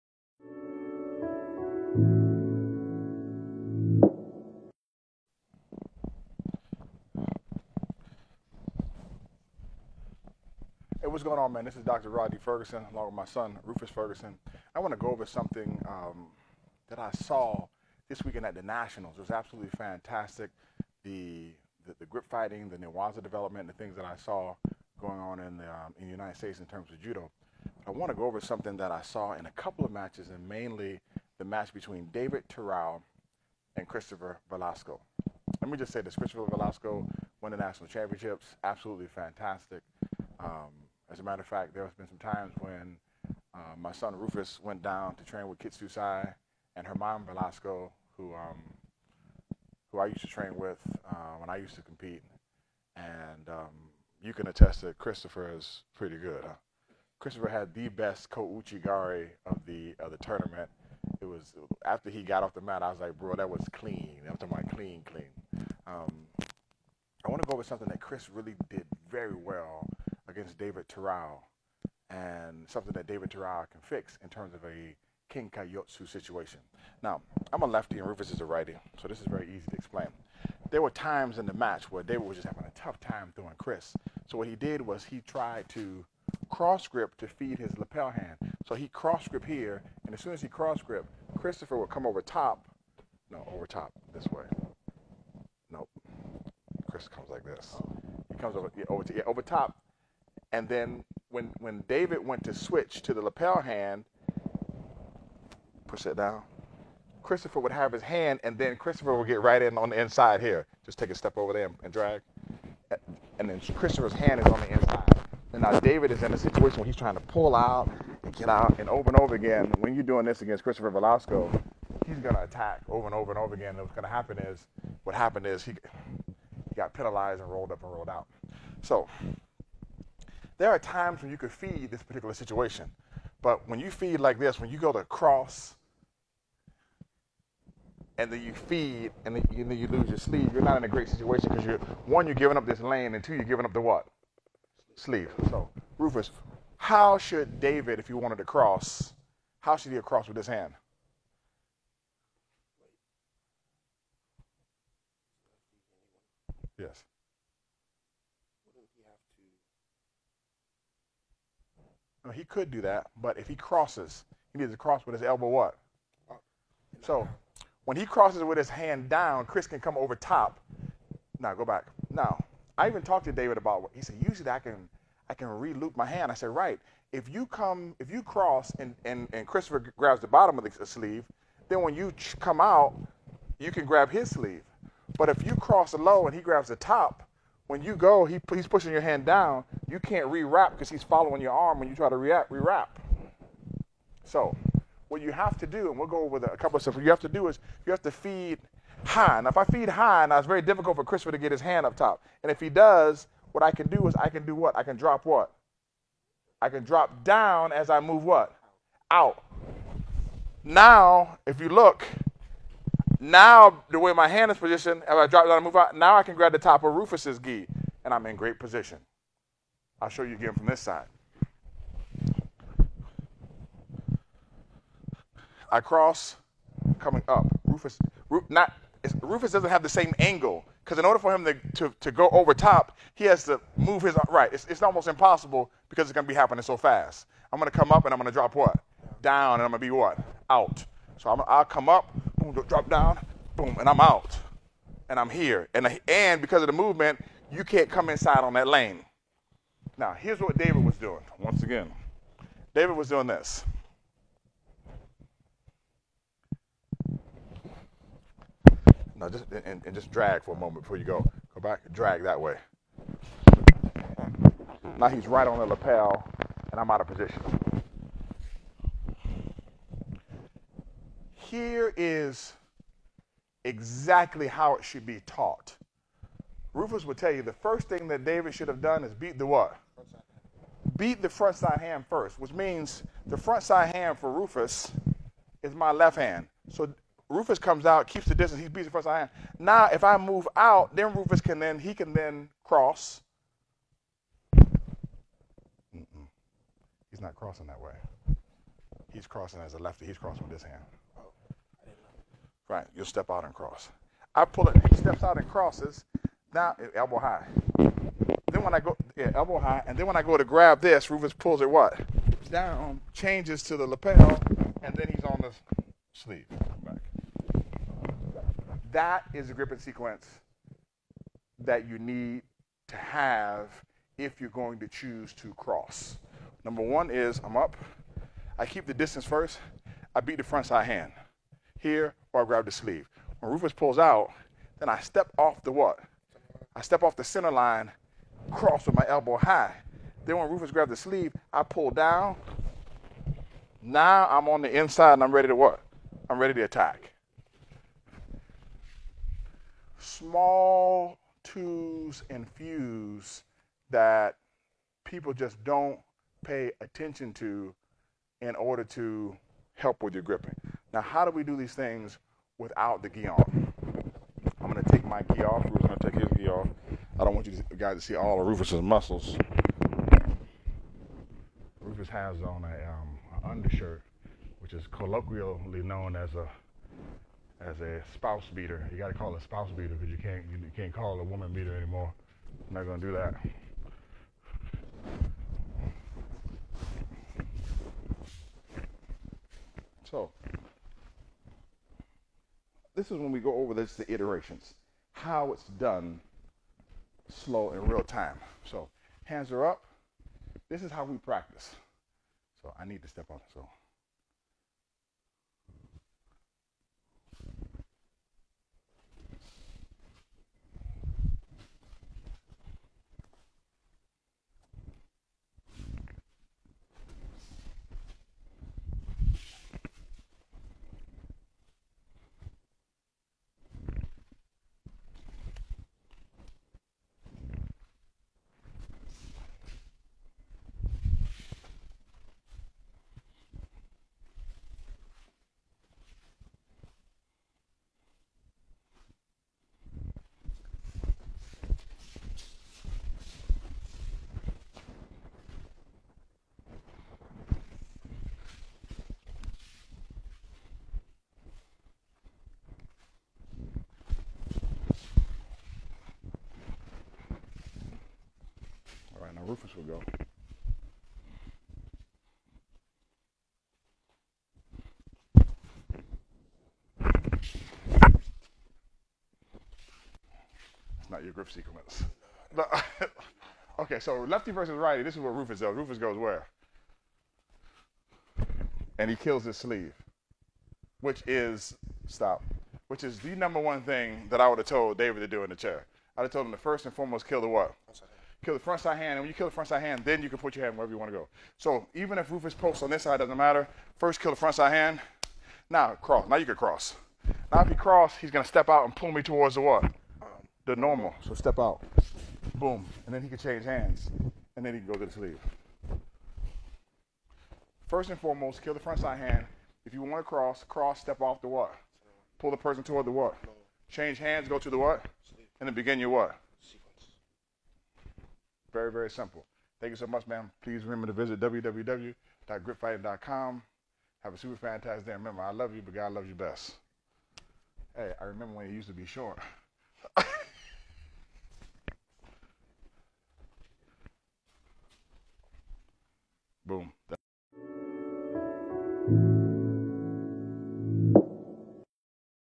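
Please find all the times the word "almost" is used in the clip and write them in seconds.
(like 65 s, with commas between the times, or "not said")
234 s.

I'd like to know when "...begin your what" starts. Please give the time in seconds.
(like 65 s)
515 s.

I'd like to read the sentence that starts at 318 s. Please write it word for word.
That is a grip and sequence that you need to have if you're going to choose to cross.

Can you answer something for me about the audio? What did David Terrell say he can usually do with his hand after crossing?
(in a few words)
re-loop my hand.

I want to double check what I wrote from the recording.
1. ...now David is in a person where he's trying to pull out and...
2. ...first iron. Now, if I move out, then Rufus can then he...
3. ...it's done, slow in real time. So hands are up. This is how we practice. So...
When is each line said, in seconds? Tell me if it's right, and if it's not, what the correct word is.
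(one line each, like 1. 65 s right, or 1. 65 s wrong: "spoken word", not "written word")
1. 115 s wrong: "situation", not "person"
2. 288 s right
3. 395 s right.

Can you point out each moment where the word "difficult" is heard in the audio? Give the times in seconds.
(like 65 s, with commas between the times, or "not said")
200 s.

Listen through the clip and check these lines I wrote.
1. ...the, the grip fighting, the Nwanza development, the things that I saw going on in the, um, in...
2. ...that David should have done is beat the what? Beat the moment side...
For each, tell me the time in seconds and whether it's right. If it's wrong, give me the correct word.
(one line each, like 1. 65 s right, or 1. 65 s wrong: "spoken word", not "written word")
1. 21 s right
2. 278 s wrong: "front", not "moment".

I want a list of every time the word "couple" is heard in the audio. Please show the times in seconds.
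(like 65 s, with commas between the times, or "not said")
29 s, 196 s.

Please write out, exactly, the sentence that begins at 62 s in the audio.
I was like, bro, that was clean.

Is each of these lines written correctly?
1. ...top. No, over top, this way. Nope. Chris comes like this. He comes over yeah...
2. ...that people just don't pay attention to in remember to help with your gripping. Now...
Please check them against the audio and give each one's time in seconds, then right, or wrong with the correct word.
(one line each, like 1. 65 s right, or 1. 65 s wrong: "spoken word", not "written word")
1. 92 s right
2. 353 s wrong: "order", not "remember".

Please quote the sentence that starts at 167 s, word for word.
So when he crosses with his hand down, Chris can come over top.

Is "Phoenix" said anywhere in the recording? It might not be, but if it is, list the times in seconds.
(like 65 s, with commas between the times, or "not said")
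not said.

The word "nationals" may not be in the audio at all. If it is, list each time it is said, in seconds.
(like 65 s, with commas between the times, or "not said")
18 s, 37 s.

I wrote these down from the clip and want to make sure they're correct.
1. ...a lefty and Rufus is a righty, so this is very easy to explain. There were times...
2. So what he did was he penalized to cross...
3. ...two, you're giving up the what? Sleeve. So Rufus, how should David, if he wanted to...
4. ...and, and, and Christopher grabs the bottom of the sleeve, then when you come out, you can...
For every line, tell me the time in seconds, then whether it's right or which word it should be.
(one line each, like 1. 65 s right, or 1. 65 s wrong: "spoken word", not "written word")
1. 77 s right
2. 84 s wrong: "tried", not "penalized"
3. 143 s right
4. 178 s right.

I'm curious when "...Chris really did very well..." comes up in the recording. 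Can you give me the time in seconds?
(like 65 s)
68 s.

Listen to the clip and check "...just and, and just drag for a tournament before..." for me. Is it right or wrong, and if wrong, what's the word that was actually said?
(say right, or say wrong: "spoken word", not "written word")
wrong: "moment", not "tournament".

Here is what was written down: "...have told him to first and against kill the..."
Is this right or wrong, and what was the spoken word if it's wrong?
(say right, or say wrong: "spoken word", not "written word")
wrong: "foremost", not "against".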